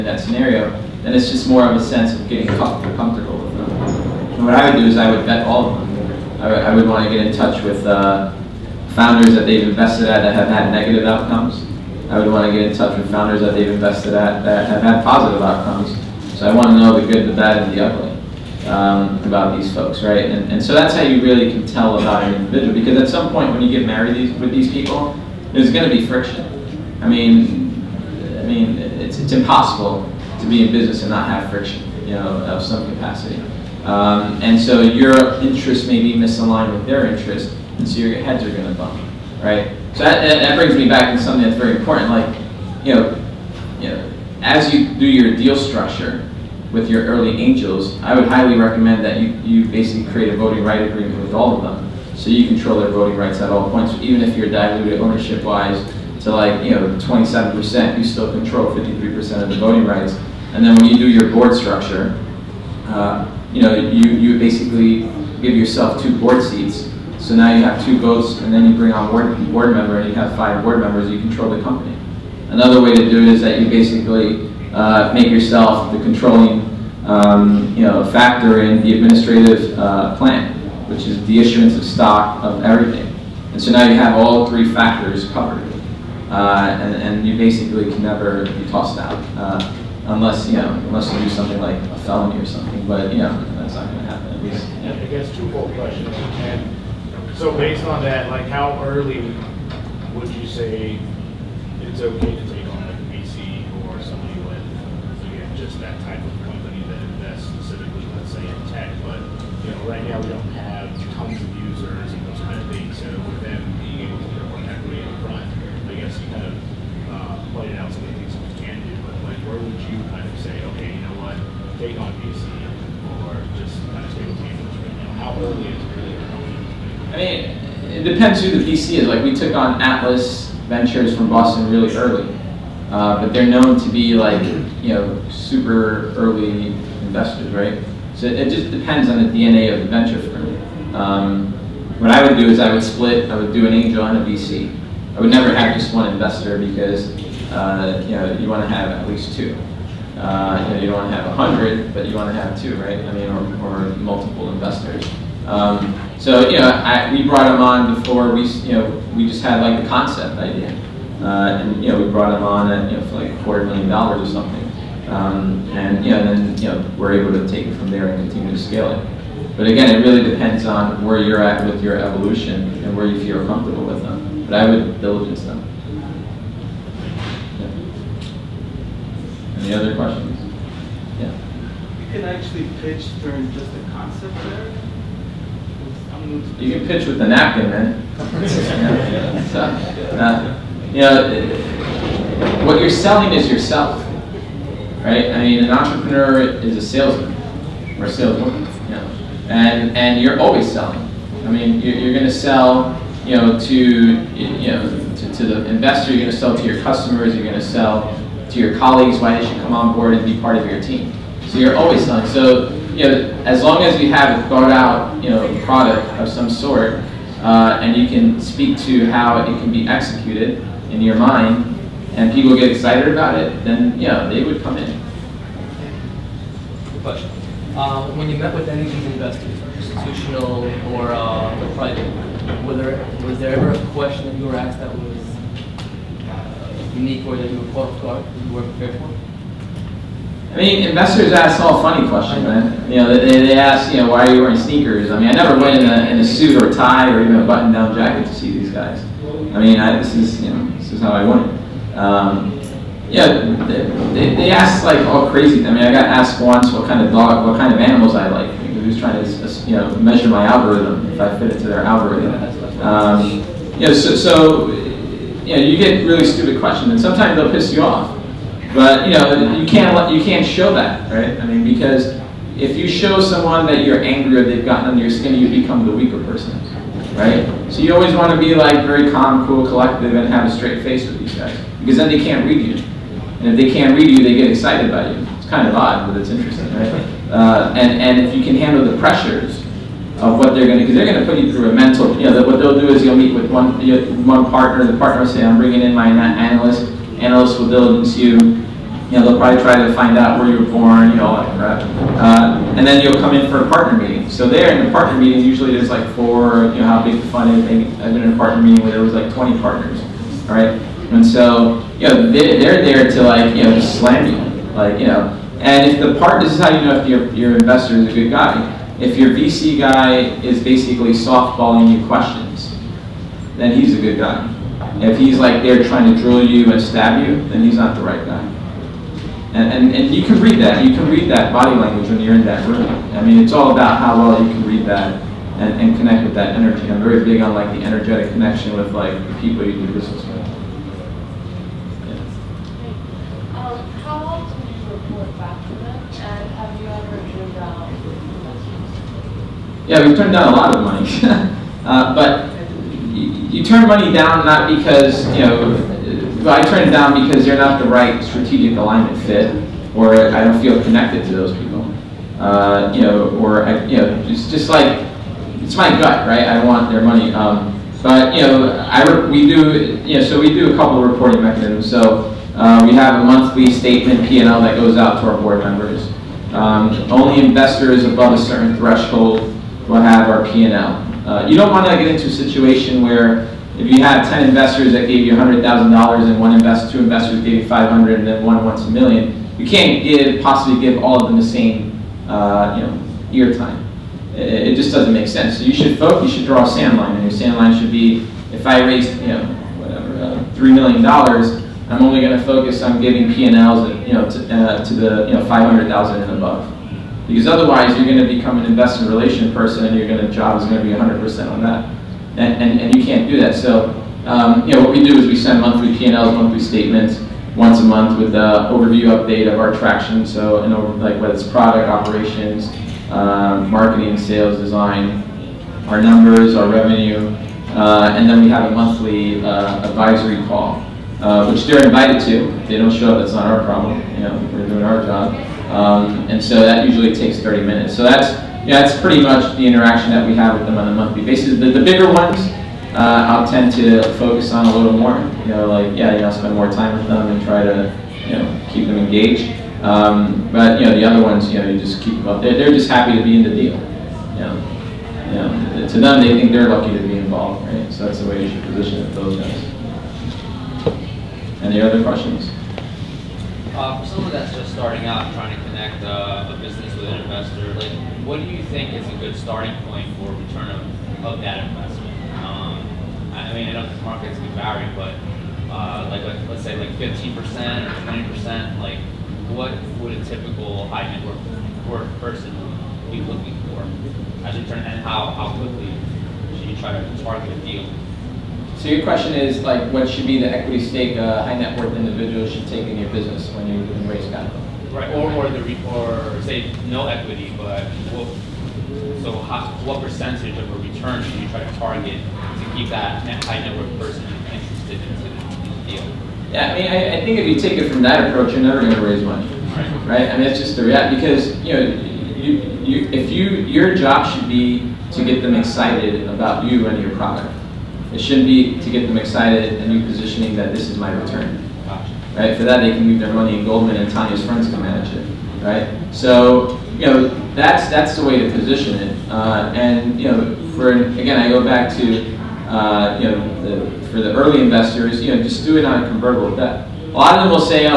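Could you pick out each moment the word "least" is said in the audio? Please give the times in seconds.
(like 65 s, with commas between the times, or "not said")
94 s, 149 s.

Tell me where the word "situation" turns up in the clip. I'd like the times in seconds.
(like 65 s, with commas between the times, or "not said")
382 s.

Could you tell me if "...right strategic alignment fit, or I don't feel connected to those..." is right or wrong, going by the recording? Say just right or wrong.
right.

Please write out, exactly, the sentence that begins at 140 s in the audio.
Um, what I would do is I would split.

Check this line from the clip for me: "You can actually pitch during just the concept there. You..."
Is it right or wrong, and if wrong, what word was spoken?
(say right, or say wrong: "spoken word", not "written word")
right.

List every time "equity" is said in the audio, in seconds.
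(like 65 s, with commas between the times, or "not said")
114 s, 490 s, 497 s.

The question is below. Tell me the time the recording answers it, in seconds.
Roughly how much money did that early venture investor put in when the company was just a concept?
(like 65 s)
163 s.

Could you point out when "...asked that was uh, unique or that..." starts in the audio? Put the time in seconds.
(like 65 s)
234 s.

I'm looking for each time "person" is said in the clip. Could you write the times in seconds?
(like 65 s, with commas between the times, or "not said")
276 s, 409 s, 482 s, 503 s.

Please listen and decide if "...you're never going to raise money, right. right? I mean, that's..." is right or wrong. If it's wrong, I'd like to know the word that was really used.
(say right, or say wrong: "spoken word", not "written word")
right.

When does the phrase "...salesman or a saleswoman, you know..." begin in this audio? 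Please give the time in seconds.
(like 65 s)
196 s.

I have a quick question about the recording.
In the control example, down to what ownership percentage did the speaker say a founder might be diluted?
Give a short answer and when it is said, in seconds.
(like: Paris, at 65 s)
27%, at 56 s.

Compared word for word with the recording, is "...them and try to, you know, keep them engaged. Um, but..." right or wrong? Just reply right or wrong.
right.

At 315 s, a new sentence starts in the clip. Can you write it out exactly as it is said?
And if the part, this is how you know if your, your investor is a good guy.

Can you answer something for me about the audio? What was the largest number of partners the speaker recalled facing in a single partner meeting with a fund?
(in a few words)
20.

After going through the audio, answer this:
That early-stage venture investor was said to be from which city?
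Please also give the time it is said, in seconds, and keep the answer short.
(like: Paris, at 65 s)
Boston, at 131 s.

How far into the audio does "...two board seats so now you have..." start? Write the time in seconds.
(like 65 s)
66 s.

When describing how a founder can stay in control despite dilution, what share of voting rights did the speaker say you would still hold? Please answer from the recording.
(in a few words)
53%.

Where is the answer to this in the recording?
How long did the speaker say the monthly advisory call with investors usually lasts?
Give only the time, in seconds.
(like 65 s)
437 s.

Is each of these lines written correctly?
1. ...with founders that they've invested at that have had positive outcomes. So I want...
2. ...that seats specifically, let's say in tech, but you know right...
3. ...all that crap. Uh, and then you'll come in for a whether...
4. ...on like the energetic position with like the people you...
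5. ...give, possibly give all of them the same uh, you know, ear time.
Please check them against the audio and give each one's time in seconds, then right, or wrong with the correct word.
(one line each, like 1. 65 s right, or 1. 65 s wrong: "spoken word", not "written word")
1. 12 s right
2. 106 s wrong: "invests", not "seats"
3. 301 s wrong: "partner", not "whether"
4. 337 s wrong: "connection", not "position"
5. 390 s right.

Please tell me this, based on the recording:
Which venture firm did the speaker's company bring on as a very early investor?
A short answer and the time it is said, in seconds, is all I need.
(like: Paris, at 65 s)
Atlas Ventures, at 129 s.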